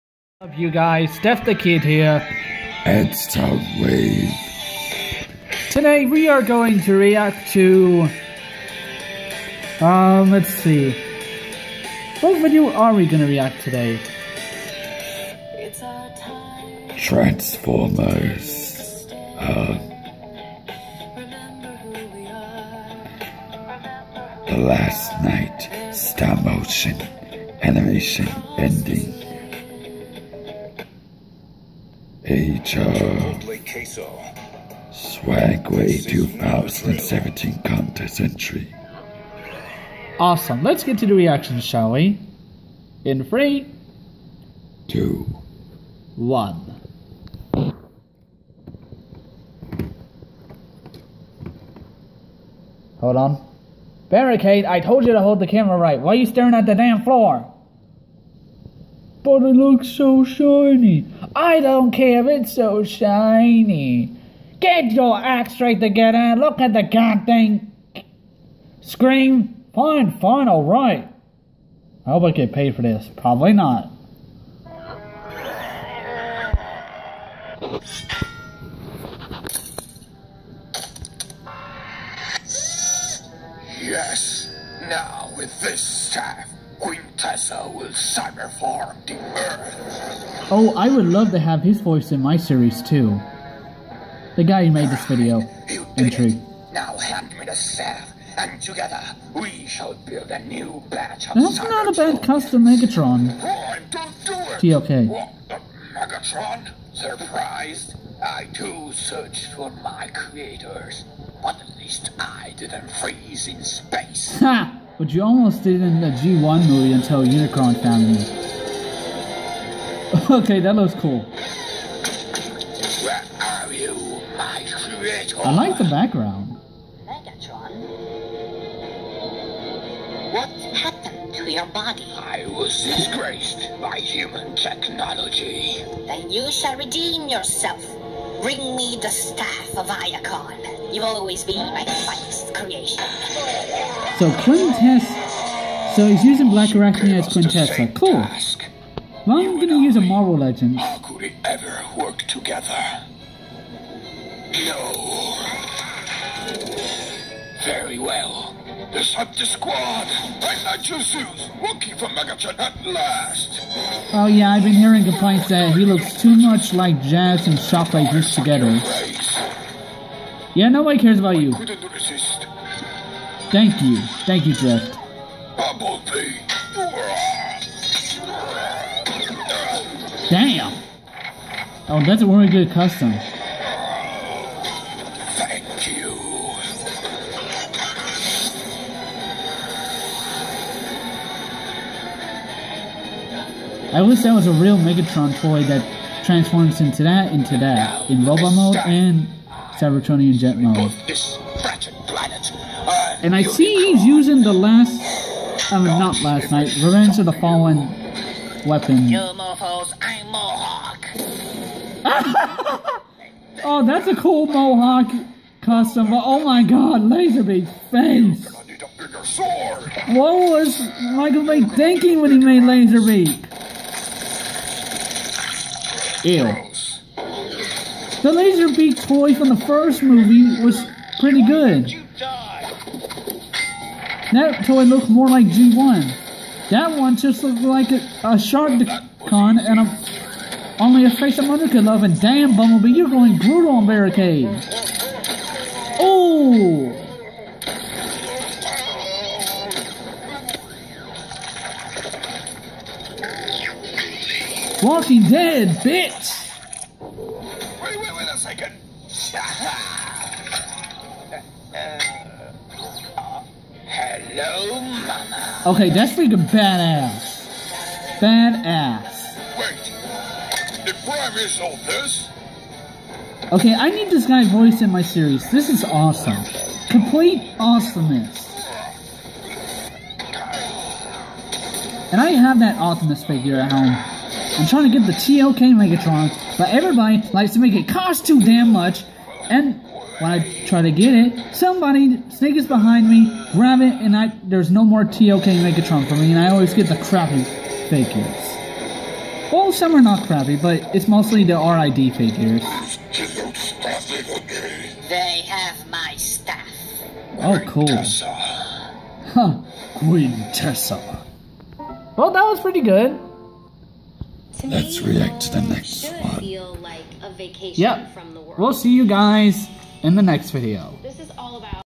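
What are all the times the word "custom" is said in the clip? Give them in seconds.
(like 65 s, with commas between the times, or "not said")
102 s, 182 s, 215 s.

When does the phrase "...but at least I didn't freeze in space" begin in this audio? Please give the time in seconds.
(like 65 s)
111 s.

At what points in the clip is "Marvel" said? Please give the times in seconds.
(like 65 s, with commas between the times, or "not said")
150 s.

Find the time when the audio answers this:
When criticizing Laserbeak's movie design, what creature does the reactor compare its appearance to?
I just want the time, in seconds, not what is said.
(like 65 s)
238 s.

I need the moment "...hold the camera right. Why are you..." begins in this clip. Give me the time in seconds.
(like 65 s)
55 s.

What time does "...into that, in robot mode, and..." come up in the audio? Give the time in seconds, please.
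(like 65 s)
197 s.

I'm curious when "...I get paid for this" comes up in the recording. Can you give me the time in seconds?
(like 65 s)
72 s.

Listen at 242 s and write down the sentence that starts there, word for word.
And damn, Bumblebee, you're going brutal on Barricade.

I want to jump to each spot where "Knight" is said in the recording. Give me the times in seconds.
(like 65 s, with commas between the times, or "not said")
25 s, 206 s.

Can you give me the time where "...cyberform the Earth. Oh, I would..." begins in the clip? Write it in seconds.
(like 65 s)
87 s.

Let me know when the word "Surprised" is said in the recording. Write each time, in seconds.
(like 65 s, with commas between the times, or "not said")
106 s.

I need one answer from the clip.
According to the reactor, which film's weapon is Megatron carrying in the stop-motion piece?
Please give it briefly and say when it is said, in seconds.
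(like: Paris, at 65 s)
Revenge of the Fallen, at 206 s.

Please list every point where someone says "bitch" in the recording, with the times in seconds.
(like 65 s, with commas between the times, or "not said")
255 s.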